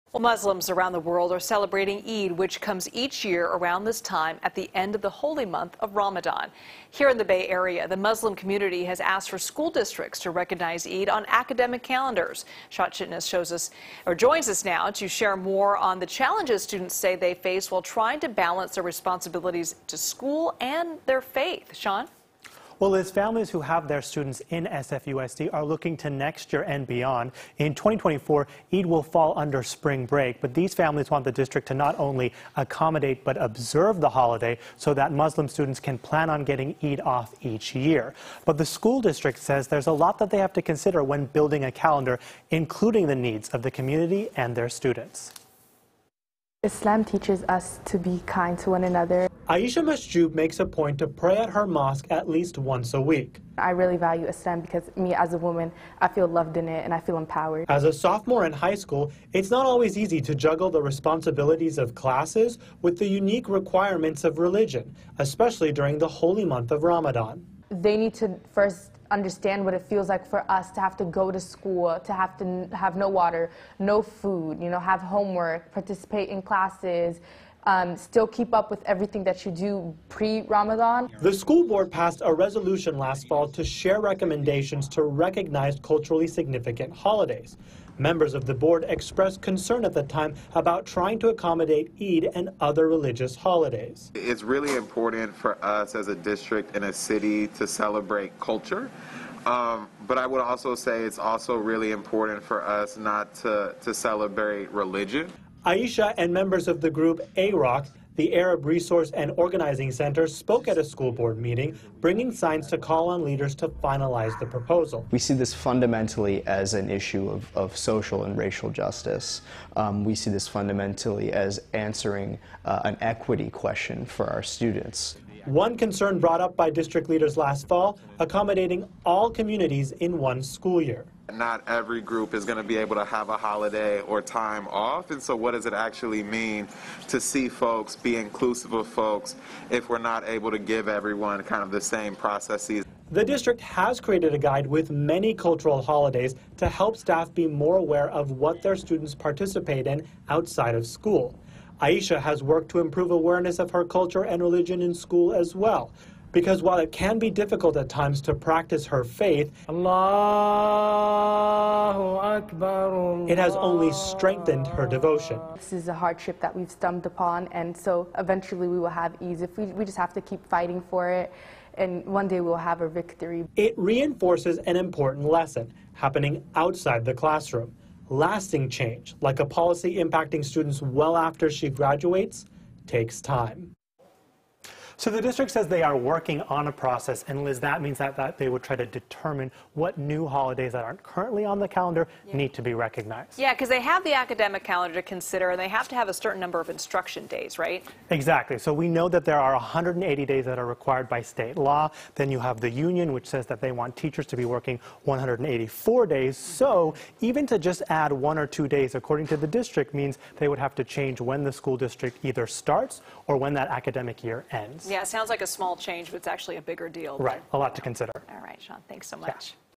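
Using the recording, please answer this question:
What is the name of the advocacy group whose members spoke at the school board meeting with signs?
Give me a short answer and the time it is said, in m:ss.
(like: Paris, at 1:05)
Arab Resource and Organizing Center, at 1:48.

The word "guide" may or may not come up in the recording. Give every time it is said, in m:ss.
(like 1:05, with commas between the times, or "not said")
2:24.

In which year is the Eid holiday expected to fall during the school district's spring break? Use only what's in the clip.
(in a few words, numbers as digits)
2024.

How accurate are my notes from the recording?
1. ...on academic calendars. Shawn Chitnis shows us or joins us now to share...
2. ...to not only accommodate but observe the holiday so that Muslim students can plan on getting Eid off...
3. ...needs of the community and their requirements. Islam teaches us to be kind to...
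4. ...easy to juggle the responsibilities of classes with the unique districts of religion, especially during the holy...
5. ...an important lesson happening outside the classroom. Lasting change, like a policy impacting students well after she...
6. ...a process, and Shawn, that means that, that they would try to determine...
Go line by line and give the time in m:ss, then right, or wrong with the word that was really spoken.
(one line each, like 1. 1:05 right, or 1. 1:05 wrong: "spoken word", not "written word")
1. 0:11 right
2. 0:31 right
3. 0:43 wrong: "students", not "requirements"
4. 0:59 wrong: "requirements", not "districts"
5. 2:54 right
6. 3:06 wrong: "Liz", not "Shawn".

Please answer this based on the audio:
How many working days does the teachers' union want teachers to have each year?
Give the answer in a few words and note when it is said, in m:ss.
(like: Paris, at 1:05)
184, at 3:25.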